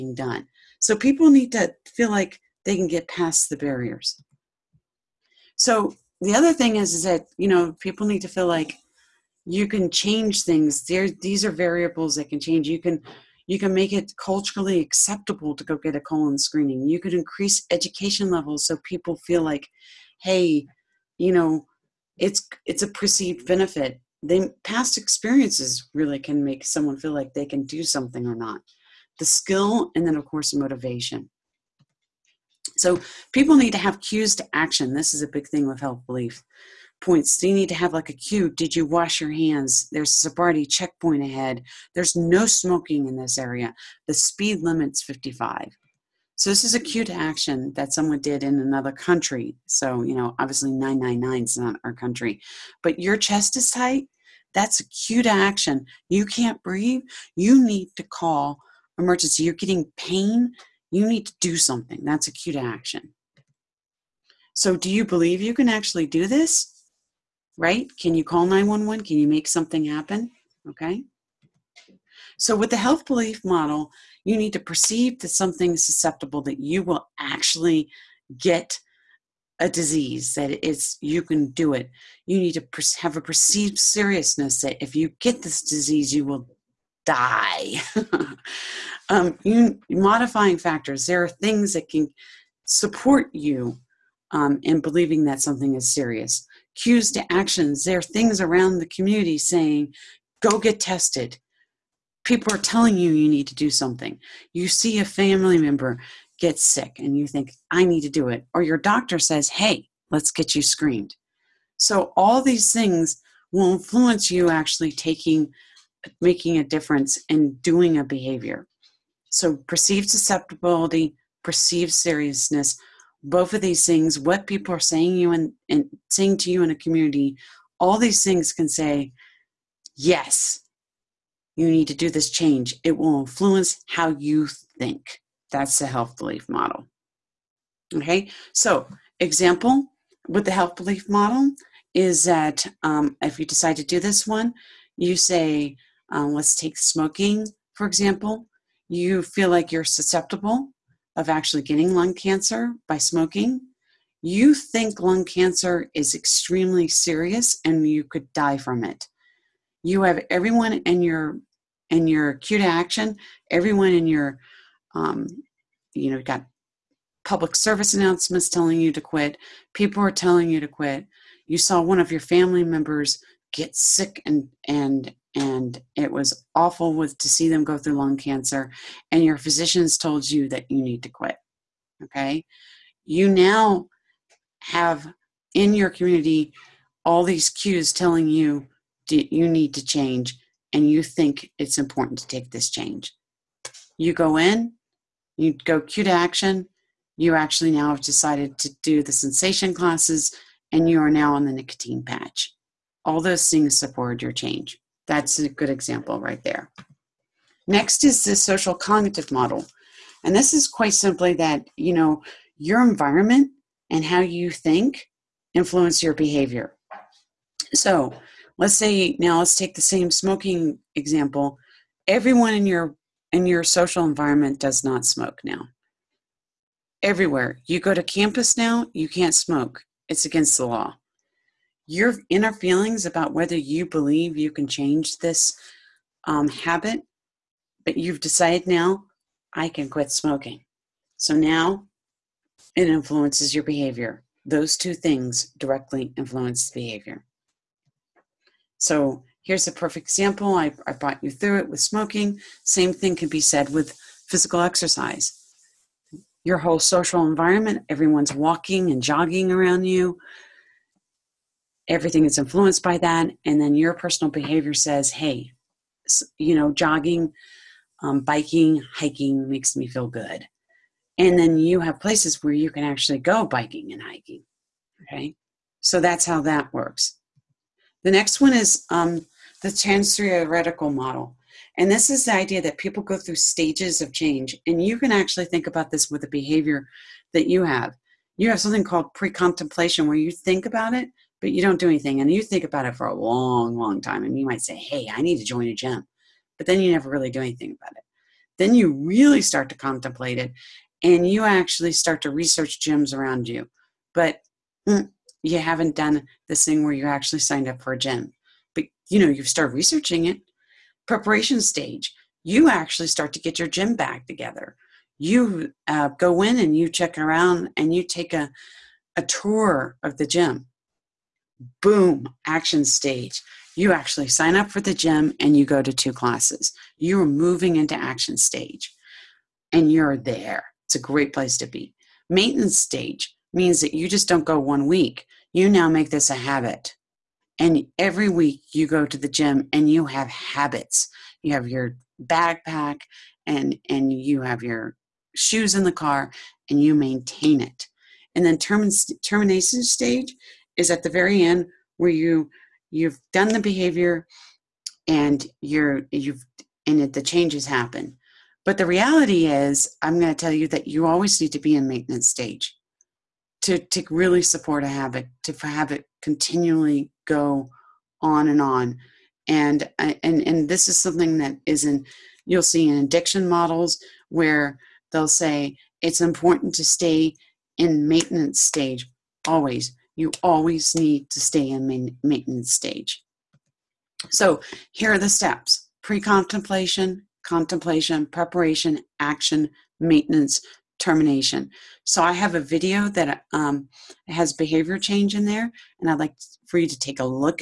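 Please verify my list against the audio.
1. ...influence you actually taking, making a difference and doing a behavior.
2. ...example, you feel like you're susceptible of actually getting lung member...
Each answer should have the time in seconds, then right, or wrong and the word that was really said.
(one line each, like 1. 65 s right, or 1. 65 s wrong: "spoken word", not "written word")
1. 113 s right
2. 147 s wrong: "cancer", not "member".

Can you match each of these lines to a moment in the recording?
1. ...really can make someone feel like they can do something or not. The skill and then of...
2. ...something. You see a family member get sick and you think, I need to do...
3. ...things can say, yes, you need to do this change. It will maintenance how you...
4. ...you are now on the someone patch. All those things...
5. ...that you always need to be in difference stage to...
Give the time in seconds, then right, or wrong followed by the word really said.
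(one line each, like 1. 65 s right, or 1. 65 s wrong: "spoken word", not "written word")
1. 25 s right
2. 103 s right
3. 128 s wrong: "influence", not "maintenance"
4. 200 s wrong: "nicotine", not "someone"
5. 360 s wrong: "maintenance", not "difference".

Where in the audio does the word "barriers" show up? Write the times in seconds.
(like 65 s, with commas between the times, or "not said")
3 s.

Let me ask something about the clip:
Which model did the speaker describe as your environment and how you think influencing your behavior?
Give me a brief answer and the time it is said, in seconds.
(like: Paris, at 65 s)
social cognitive model, at 208 s.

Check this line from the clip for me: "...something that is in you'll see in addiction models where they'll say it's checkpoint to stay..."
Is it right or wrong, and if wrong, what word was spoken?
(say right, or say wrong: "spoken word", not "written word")
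wrong: "important", not "checkpoint".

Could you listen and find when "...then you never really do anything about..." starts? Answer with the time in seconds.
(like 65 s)
296 s.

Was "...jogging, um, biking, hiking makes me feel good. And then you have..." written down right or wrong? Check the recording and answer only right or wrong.
right.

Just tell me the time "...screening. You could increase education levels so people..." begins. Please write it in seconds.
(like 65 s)
16 s.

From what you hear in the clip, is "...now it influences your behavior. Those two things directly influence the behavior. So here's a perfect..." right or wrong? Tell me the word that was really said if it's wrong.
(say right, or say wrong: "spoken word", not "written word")
right.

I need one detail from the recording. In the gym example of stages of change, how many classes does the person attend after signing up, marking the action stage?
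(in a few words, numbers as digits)
2.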